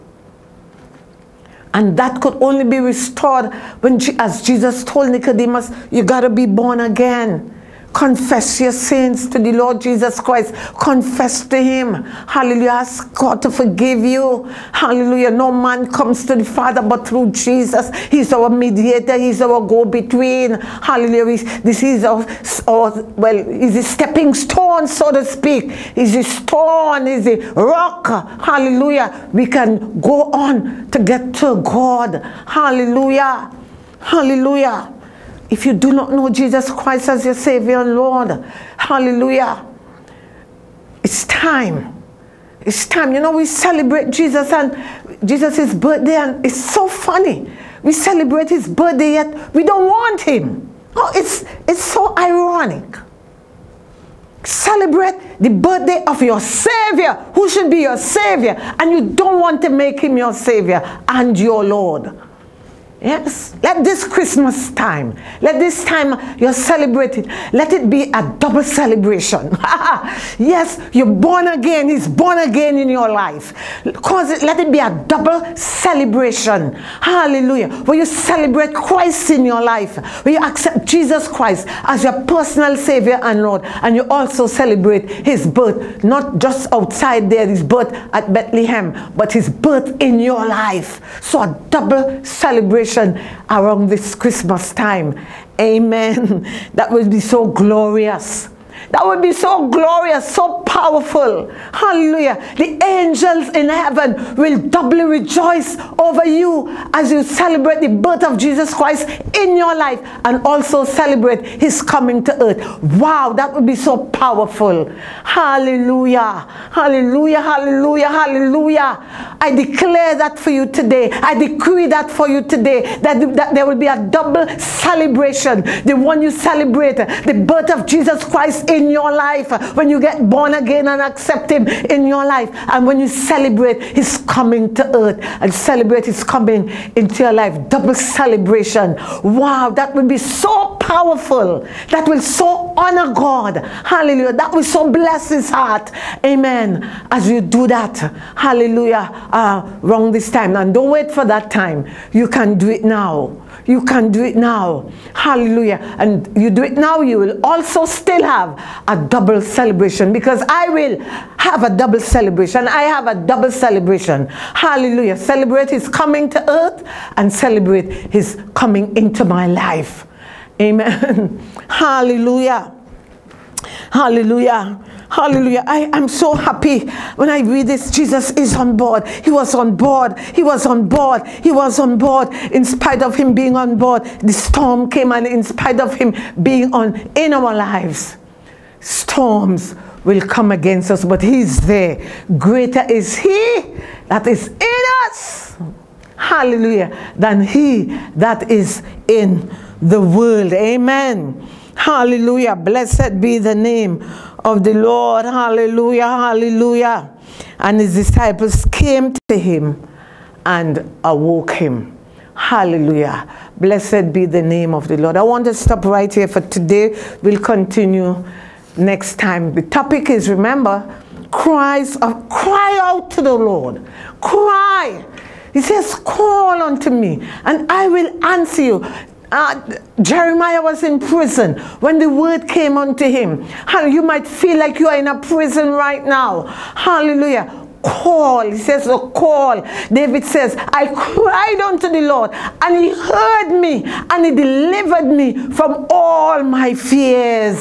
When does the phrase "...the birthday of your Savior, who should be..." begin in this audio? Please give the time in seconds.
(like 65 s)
55 s.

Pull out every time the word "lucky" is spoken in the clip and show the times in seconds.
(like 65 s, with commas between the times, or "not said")
not said.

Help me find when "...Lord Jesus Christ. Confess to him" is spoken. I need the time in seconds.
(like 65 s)
9 s.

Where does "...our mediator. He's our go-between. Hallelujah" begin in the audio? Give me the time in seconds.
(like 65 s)
18 s.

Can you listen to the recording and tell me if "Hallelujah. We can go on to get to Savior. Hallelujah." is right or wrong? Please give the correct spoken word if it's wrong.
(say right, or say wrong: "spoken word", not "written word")
wrong: "God", not "Savior".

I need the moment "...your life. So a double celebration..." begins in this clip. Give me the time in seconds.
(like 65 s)
90 s.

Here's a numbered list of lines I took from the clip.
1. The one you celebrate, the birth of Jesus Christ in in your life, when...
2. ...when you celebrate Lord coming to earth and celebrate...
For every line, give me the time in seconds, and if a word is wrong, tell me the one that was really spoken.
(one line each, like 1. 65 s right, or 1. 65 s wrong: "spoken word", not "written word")
1. 125 s right
2. 132 s wrong: "His", not "Lord".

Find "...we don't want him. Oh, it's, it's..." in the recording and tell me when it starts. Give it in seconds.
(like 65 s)
49 s.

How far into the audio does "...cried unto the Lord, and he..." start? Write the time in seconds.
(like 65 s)
240 s.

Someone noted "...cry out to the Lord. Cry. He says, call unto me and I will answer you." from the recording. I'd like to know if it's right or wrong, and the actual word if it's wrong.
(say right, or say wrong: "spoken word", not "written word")
right.